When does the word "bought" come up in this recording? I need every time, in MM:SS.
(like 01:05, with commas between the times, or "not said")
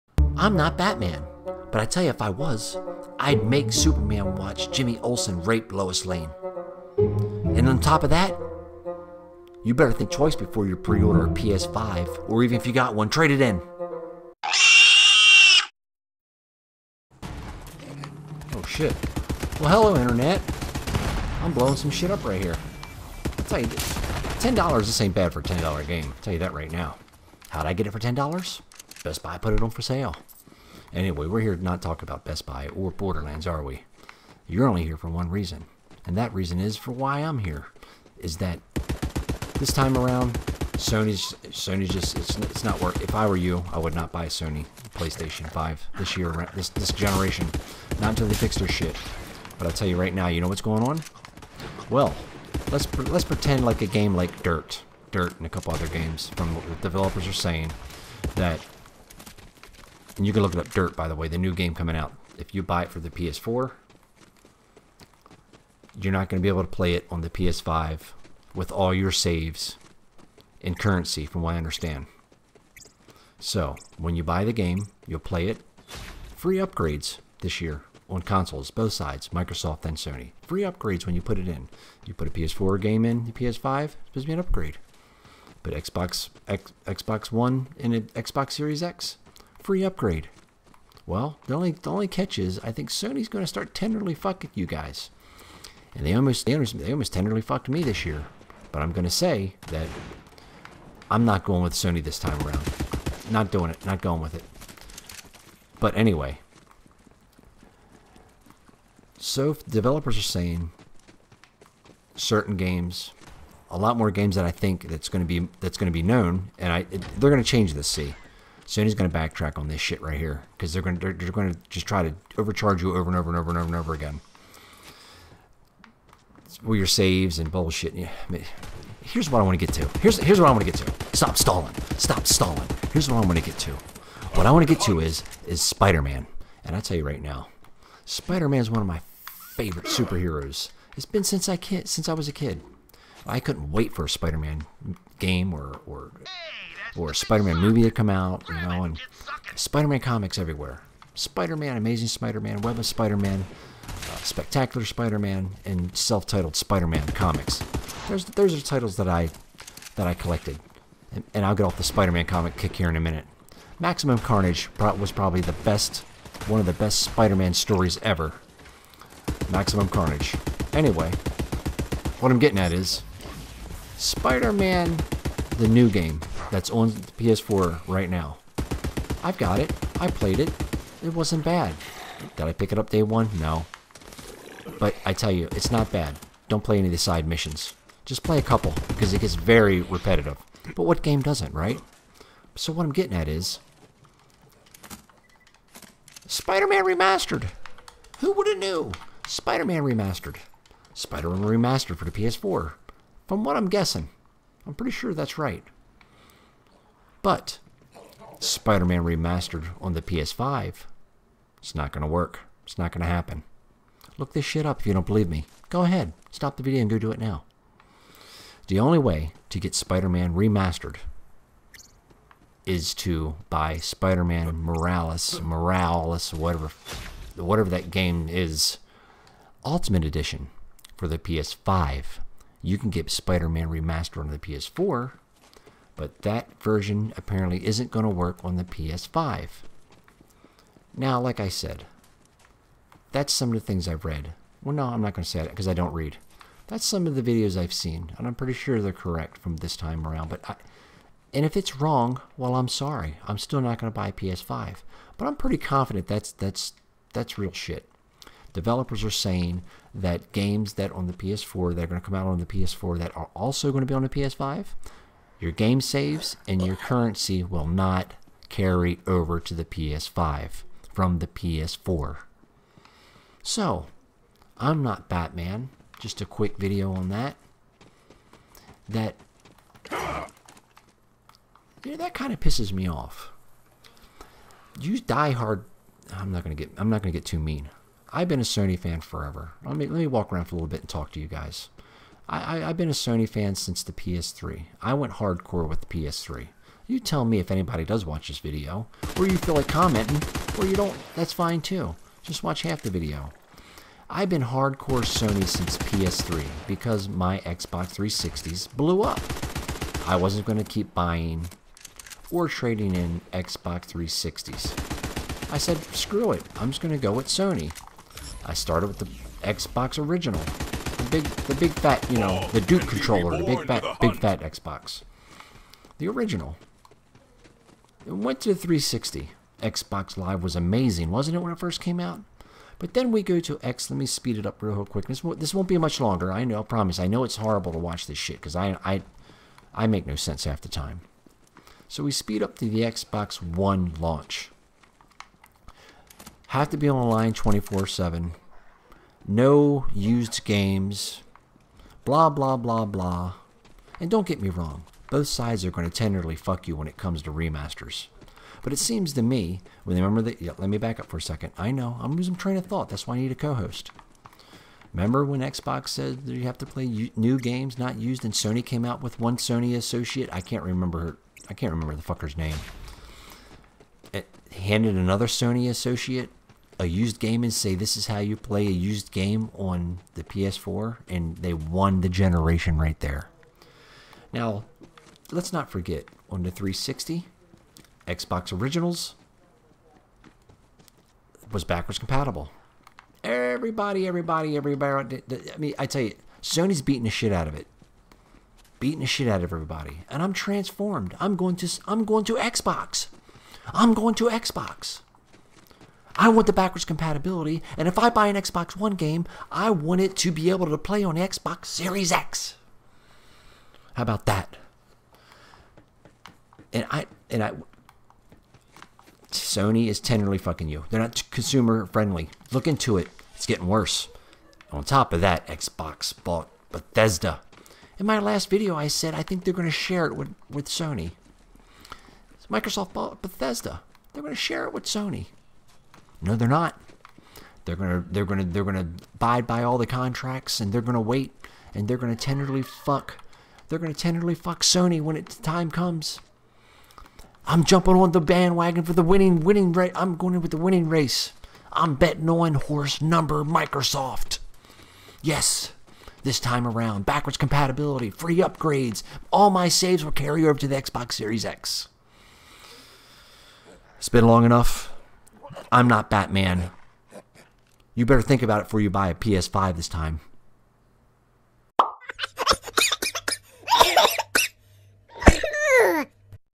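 07:06, 07:12.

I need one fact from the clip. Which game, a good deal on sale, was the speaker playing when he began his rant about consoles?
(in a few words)
Borderlands.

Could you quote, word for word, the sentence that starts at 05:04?
I've been hardcore Sony since PS3 because my Xbox 360s blew up.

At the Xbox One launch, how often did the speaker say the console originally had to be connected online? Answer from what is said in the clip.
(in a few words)
24/7.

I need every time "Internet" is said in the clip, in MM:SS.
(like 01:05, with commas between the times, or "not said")
00:20.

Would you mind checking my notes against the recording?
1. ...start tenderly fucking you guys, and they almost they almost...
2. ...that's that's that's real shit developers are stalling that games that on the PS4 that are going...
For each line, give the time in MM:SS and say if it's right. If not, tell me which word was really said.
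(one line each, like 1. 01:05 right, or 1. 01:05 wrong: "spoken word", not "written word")
1. 01:33 right
2. 04:16 wrong: "saying", not "stalling".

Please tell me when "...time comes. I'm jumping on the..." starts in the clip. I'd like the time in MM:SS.
07:25.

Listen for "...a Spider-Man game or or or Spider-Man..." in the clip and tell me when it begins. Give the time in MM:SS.
02:24.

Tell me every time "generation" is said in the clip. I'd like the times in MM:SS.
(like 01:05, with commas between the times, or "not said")
00:46, 06:22.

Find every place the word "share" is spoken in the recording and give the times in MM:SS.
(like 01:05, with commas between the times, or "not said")
07:09, 07:14.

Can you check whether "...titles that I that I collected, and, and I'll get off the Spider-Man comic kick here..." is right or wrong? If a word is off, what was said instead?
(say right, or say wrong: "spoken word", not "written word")
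right.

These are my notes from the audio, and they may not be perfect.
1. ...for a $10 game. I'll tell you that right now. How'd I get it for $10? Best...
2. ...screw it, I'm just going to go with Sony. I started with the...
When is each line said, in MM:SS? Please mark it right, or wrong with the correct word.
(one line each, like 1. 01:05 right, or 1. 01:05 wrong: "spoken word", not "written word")
1. 00:25 right
2. 05:15 right.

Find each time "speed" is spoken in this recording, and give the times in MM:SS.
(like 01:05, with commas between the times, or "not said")
05:34, 05:42.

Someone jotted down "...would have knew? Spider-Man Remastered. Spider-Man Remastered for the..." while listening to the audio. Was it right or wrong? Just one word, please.
right.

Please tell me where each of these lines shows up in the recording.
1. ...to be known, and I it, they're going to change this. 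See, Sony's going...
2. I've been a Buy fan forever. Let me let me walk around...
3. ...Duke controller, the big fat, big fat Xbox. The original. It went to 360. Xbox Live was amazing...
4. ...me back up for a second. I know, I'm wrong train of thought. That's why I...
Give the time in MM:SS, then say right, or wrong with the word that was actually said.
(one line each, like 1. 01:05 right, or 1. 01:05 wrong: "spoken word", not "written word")
1. 01:55 right
2. 04:48 wrong: "Sony", not "Buy"
3. 05:22 right
4. 06:00 wrong: "losing", not "wrong".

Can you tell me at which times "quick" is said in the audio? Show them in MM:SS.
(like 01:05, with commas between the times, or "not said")
04:36, 05:34.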